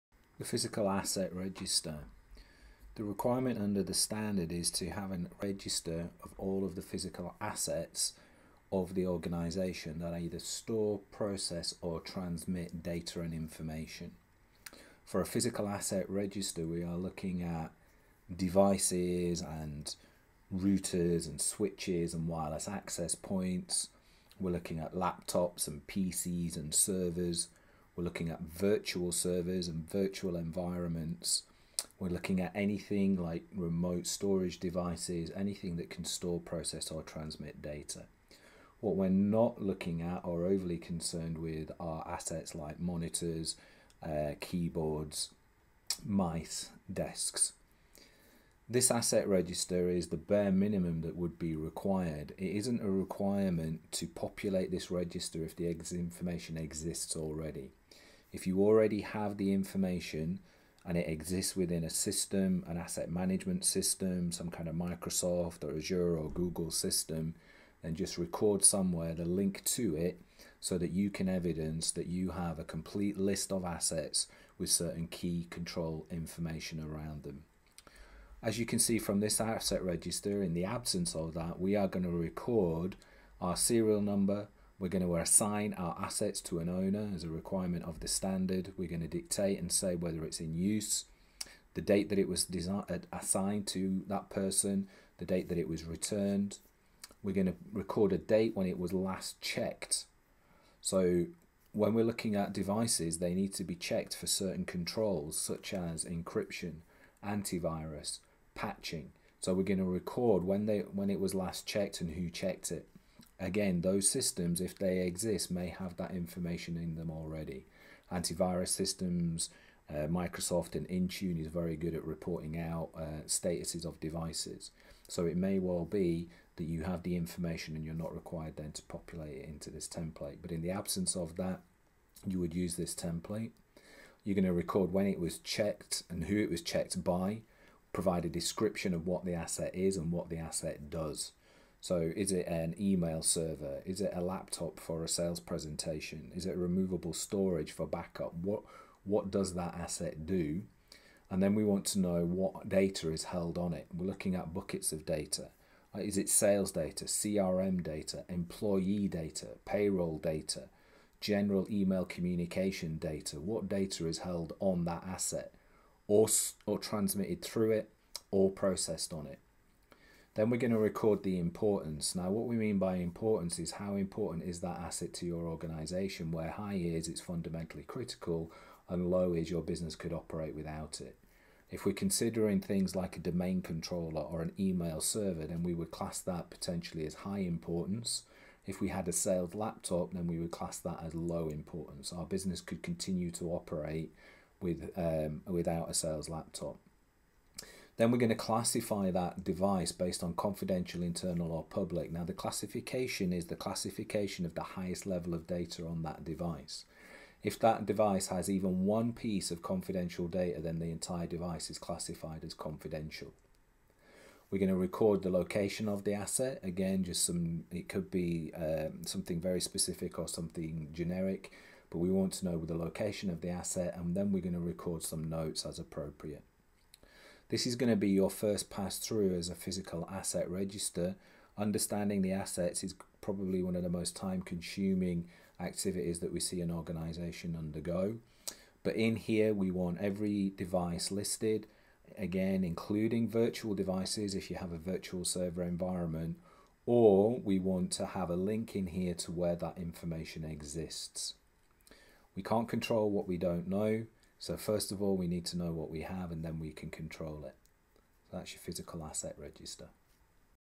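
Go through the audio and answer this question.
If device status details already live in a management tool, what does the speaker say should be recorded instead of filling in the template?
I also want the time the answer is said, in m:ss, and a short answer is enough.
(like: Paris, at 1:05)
The link to it, at 1:09.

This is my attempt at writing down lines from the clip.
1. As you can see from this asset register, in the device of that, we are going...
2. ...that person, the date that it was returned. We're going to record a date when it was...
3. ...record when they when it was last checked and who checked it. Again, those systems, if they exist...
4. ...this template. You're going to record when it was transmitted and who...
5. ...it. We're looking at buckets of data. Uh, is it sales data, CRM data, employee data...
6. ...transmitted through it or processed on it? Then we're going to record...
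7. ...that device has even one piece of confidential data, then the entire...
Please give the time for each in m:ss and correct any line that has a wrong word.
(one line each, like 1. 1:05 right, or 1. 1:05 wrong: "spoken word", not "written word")
1. 1:18 wrong: "absence", not "device"
2. 1:34 right
3. 1:49 right
4. 2:12 wrong: "checked", not "transmitted"
5. 2:33 right
6. 2:46 right
7. 3:27 right.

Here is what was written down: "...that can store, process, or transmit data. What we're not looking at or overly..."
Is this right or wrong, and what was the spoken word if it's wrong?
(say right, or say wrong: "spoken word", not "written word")
right.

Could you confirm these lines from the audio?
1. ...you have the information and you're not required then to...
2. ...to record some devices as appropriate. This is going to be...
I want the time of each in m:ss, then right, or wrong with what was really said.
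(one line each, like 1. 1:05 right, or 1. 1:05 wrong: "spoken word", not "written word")
1. 2:06 right
2. 3:44 wrong: "notes", not "devices".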